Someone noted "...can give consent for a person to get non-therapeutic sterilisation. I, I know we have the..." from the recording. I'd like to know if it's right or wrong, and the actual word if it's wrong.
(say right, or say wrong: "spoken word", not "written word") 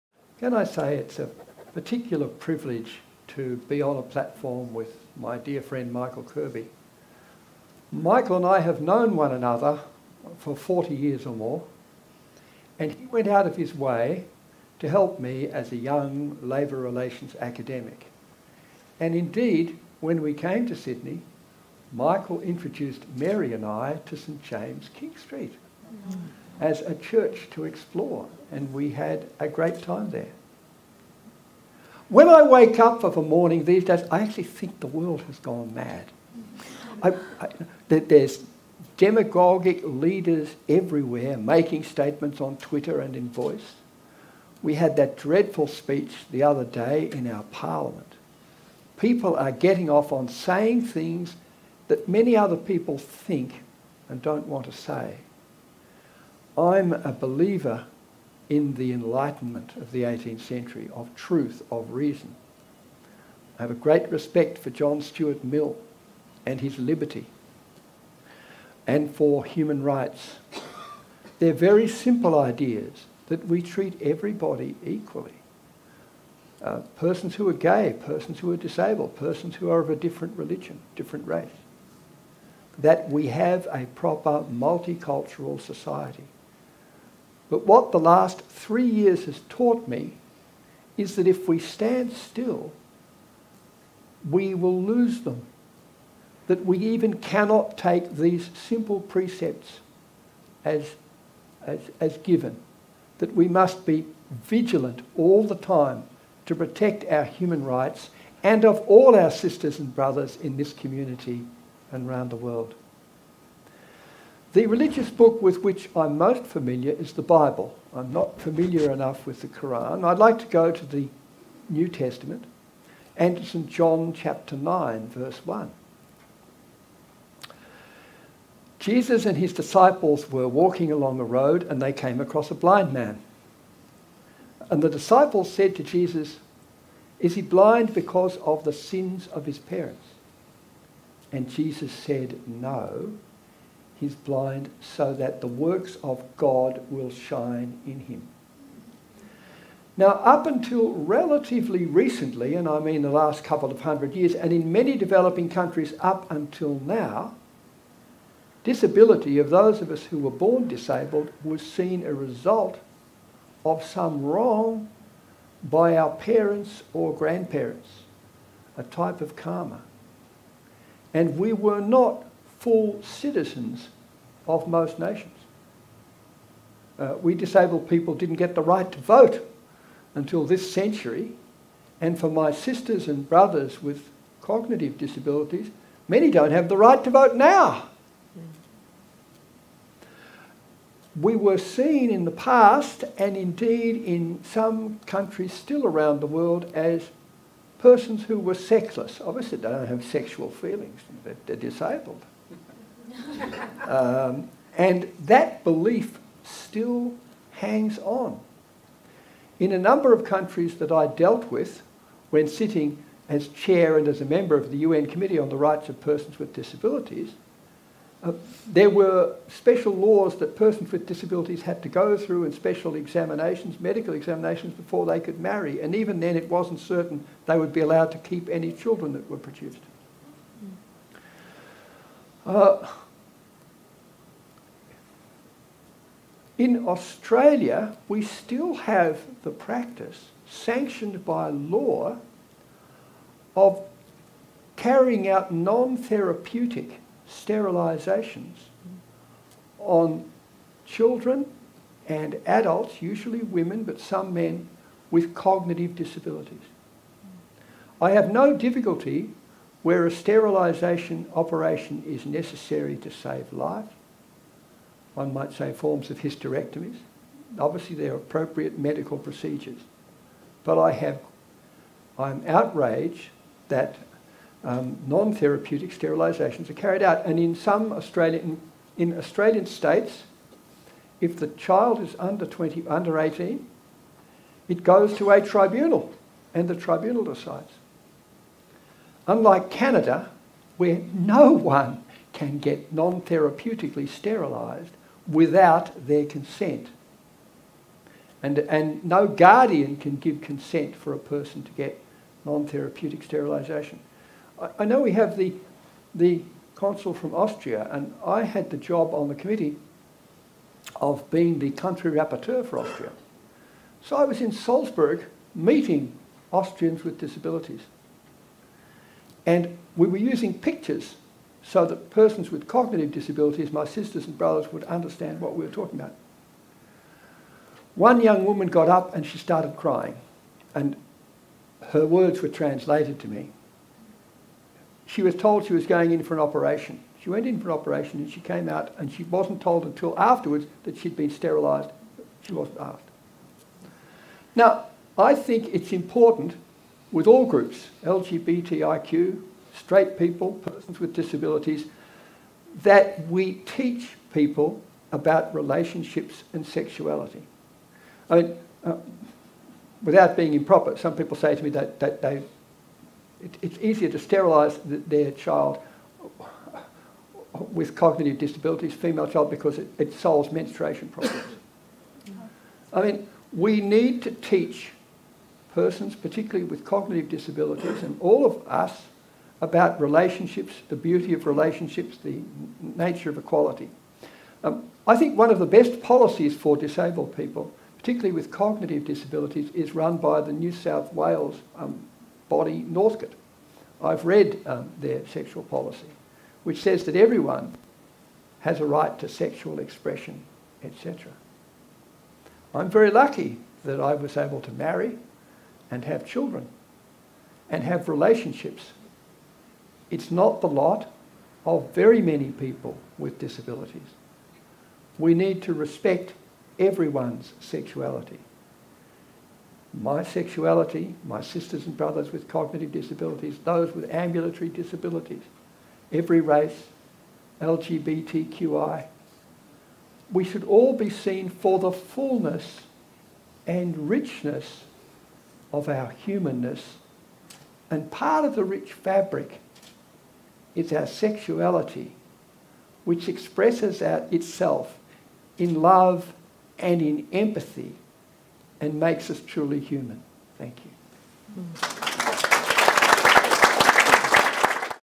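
right.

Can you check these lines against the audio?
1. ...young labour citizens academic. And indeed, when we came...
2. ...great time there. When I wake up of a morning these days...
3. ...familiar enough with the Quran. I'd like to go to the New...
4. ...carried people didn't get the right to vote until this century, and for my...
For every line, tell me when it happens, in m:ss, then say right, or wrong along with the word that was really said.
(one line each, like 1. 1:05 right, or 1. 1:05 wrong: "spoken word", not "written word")
1. 0:15 wrong: "relations", not "citizens"
2. 0:29 right
3. 1:58 right
4. 2:57 wrong: "disabled", not "carried".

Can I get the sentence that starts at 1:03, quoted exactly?
I have a great respect for John Stuart Mill and his liberty and for human rights.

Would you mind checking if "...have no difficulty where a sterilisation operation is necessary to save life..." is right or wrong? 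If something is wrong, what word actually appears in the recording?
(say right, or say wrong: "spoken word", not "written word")
right.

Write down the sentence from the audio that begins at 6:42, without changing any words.
I'm very lucky that I was able to marry and have children and have relationships.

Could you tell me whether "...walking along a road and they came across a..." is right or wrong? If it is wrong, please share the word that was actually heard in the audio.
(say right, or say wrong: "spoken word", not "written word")
right.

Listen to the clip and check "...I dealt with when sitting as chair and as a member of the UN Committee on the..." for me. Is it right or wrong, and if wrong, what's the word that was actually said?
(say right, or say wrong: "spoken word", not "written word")
right.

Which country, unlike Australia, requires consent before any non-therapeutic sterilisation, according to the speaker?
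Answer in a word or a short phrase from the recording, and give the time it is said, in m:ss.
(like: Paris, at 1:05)
Canada, at 4:49.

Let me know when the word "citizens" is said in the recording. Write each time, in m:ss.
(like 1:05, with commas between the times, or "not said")
2:53.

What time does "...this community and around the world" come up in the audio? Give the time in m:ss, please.
1:50.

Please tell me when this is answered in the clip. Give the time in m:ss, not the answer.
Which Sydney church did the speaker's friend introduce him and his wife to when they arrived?
0:24.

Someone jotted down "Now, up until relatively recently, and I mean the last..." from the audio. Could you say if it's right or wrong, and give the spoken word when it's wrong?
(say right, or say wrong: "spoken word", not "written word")
right.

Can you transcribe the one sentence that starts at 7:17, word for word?
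And part of the rich fabric is our sexuality, which expresses itself in love and in empathy and makes us truly human.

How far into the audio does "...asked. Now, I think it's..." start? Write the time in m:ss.
5:42.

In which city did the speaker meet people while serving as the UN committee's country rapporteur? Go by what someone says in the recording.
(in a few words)
Salzburg.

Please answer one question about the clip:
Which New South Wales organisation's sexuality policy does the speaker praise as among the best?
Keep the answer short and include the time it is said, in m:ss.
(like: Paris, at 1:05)
Northcott, at 6:32.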